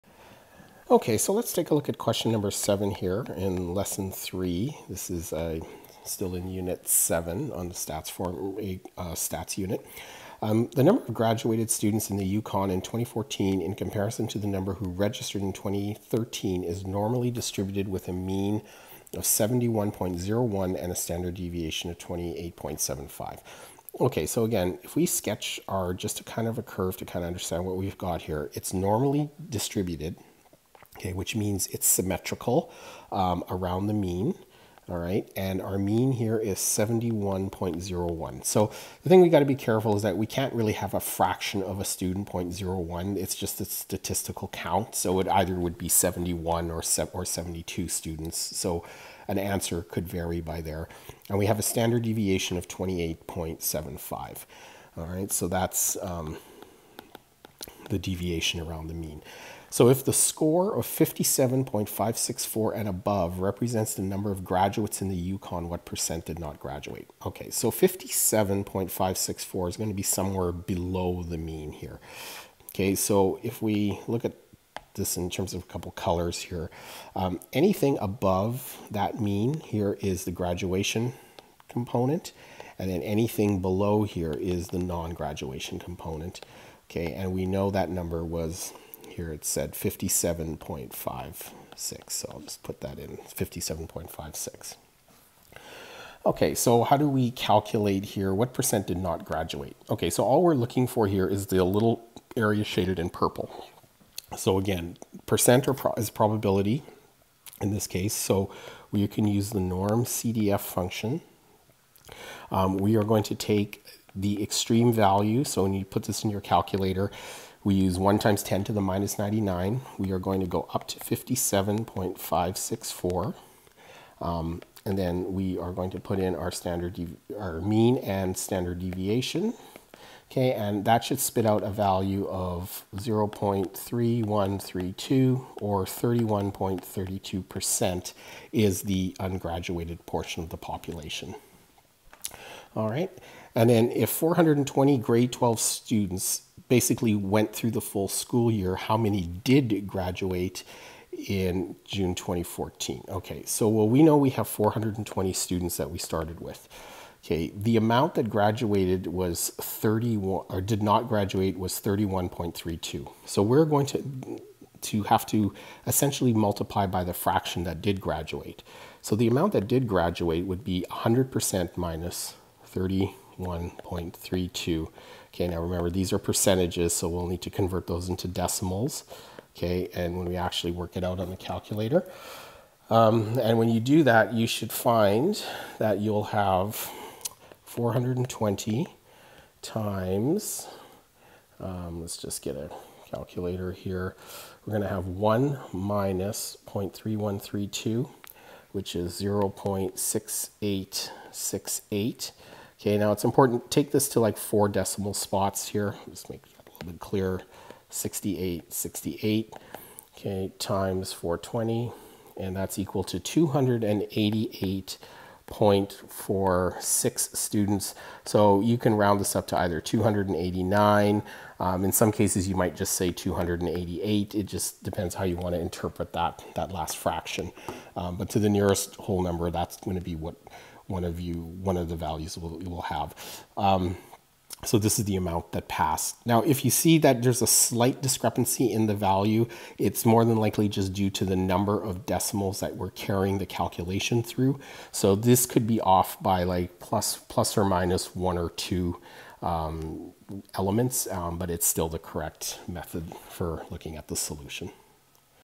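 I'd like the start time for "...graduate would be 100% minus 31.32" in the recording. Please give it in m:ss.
2:49.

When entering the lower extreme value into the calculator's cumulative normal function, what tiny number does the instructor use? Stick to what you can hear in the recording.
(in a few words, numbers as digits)
1 times 10 to the minus 99.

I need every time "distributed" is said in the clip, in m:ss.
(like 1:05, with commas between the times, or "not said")
0:17, 0:29.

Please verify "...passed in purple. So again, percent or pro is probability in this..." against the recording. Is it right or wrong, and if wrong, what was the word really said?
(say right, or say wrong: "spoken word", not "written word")
wrong: "shaded", not "passed".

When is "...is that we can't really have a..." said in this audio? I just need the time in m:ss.
0:39.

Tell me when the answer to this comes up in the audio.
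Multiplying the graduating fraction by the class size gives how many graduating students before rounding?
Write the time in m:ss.
3:33.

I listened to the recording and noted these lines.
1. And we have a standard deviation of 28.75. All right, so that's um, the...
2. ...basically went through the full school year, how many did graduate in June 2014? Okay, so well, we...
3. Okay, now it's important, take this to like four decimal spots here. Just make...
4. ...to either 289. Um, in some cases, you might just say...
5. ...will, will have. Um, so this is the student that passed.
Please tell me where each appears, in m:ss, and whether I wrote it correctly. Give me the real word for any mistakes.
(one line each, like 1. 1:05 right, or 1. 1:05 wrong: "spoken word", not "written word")
1. 0:51 right
2. 2:26 right
3. 3:22 right
4. 3:39 right
5. 3:52 wrong: "amount", not "student".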